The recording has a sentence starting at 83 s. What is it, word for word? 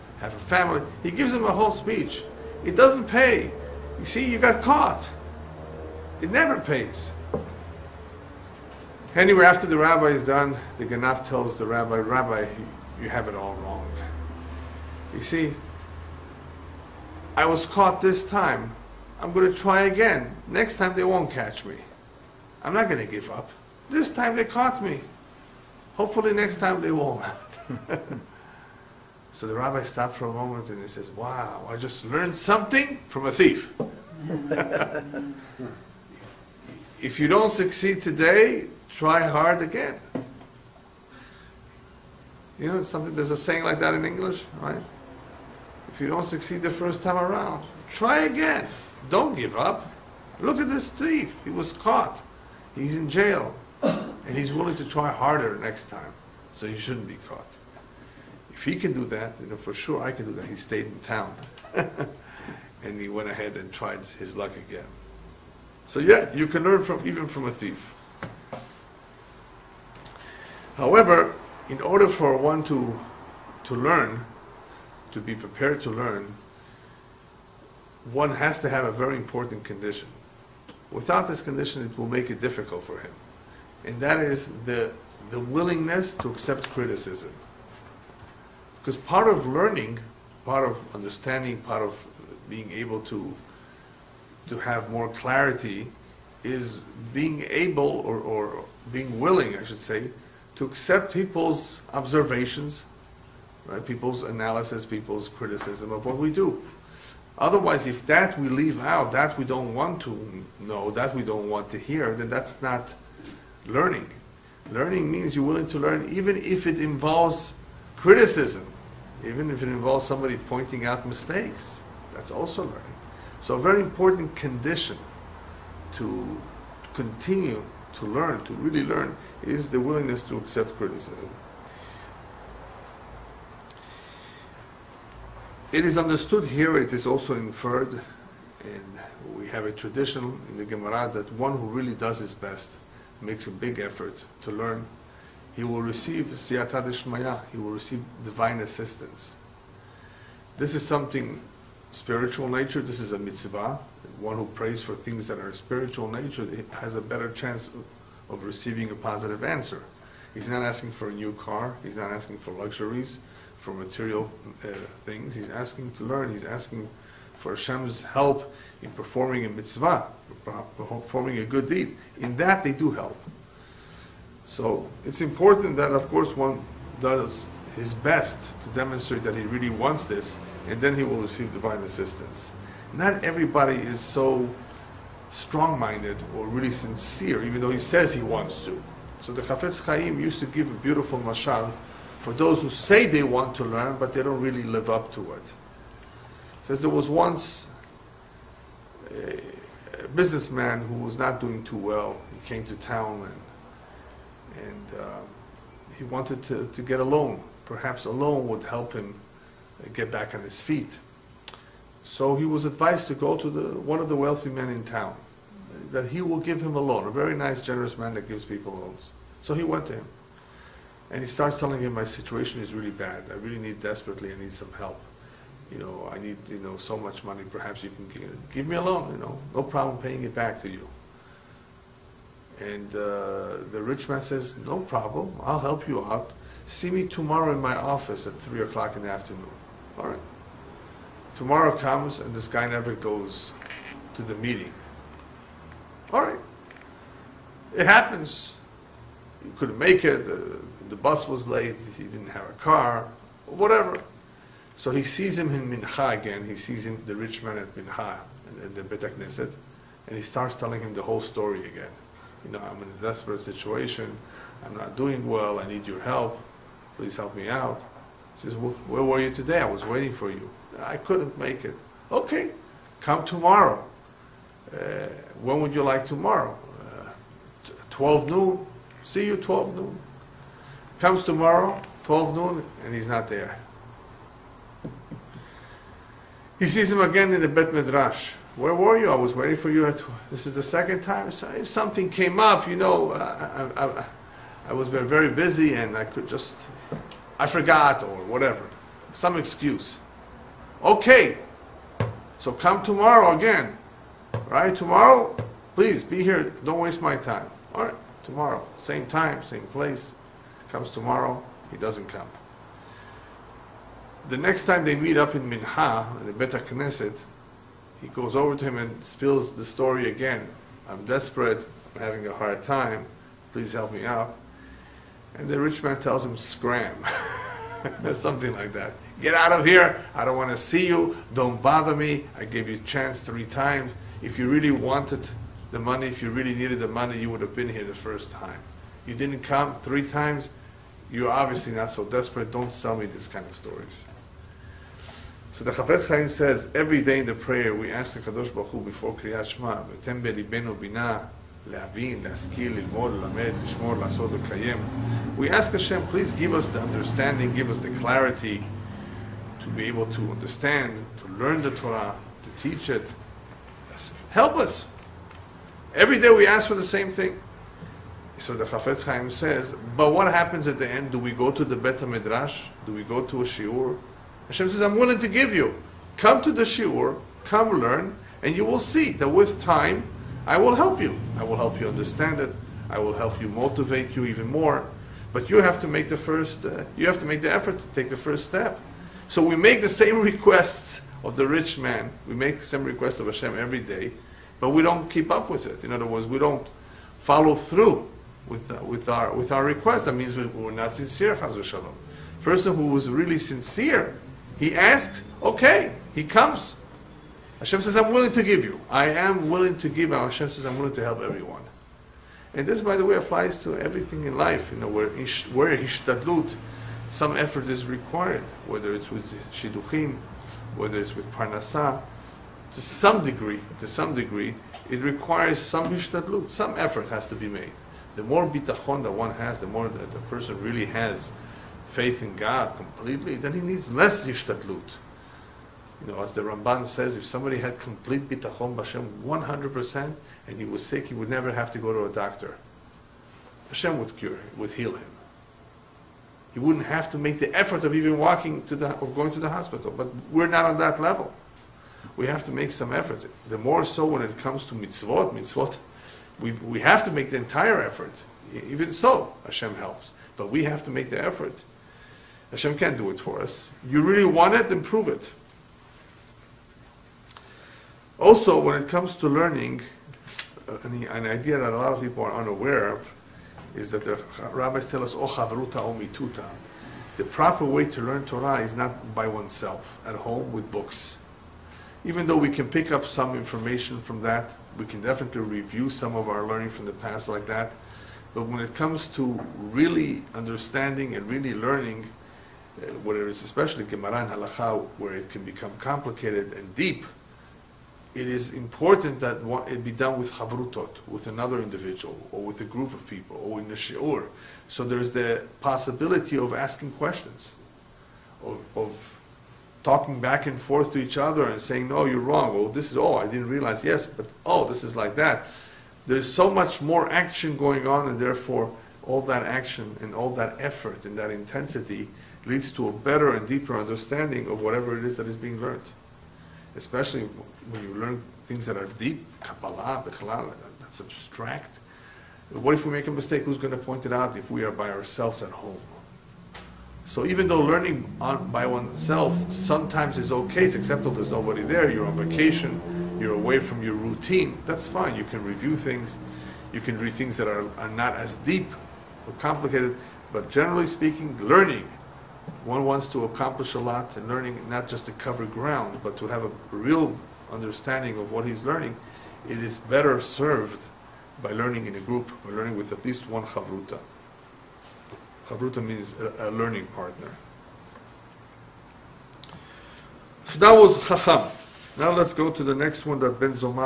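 And that is the, the willingness to accept criticism.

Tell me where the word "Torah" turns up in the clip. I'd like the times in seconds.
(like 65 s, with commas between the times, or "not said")
361 s, 478 s.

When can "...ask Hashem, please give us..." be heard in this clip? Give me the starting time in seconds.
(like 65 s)
355 s.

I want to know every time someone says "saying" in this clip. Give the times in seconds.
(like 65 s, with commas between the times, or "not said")
43 s, 511 s.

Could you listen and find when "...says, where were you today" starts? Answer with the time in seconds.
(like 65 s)
268 s.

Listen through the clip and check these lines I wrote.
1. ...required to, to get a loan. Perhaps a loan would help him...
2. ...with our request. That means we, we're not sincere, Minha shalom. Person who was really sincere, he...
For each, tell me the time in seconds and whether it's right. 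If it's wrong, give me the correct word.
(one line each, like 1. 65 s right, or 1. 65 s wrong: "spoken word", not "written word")
1. 206 s wrong: "wanted", not "required"
2. 399 s wrong: "Chaz", not "Minha".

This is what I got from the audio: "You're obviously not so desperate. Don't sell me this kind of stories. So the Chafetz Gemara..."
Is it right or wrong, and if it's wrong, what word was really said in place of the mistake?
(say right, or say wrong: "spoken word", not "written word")
wrong: "Chaim", not "Gemara".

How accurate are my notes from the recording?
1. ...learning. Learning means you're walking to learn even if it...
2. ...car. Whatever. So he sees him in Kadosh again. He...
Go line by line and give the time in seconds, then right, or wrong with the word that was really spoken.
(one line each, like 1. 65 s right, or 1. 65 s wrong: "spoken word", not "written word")
1. 113 s wrong: "willing", not "walking"
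2. 252 s wrong: "Mincha", not "Kadosh".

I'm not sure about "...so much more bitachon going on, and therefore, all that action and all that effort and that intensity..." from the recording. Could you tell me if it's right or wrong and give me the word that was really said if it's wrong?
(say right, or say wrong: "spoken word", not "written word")
wrong: "action", not "bitachon".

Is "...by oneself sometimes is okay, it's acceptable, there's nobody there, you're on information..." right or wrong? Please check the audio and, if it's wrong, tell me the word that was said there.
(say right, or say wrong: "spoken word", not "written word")
wrong: "vacation", not "information".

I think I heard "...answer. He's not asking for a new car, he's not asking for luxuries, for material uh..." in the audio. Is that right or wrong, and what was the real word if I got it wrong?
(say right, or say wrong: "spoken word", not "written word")
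right.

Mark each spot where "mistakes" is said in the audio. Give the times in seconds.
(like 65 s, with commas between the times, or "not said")
121 s, 533 s.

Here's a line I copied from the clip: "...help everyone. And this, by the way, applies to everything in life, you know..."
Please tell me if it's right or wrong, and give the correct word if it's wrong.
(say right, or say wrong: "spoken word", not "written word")
right.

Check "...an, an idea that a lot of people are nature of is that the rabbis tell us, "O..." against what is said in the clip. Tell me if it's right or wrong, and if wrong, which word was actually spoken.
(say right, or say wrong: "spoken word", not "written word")
wrong: "unaware", not "nature".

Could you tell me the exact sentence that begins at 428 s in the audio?
The more bitachon that one has, the more that the person really has faith in God completely, then he needs less hishtadlut.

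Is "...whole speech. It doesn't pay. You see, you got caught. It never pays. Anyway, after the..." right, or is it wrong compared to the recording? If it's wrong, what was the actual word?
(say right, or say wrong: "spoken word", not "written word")
right.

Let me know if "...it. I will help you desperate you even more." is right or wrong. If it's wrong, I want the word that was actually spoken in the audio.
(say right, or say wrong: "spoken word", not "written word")
wrong: "motivate", not "desperate".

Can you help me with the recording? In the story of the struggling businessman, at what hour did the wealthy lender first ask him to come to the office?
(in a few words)
3 o'clock.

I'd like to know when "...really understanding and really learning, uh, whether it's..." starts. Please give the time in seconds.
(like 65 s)
489 s.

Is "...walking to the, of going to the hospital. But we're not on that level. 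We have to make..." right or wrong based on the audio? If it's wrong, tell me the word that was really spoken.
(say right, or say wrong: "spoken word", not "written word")
right.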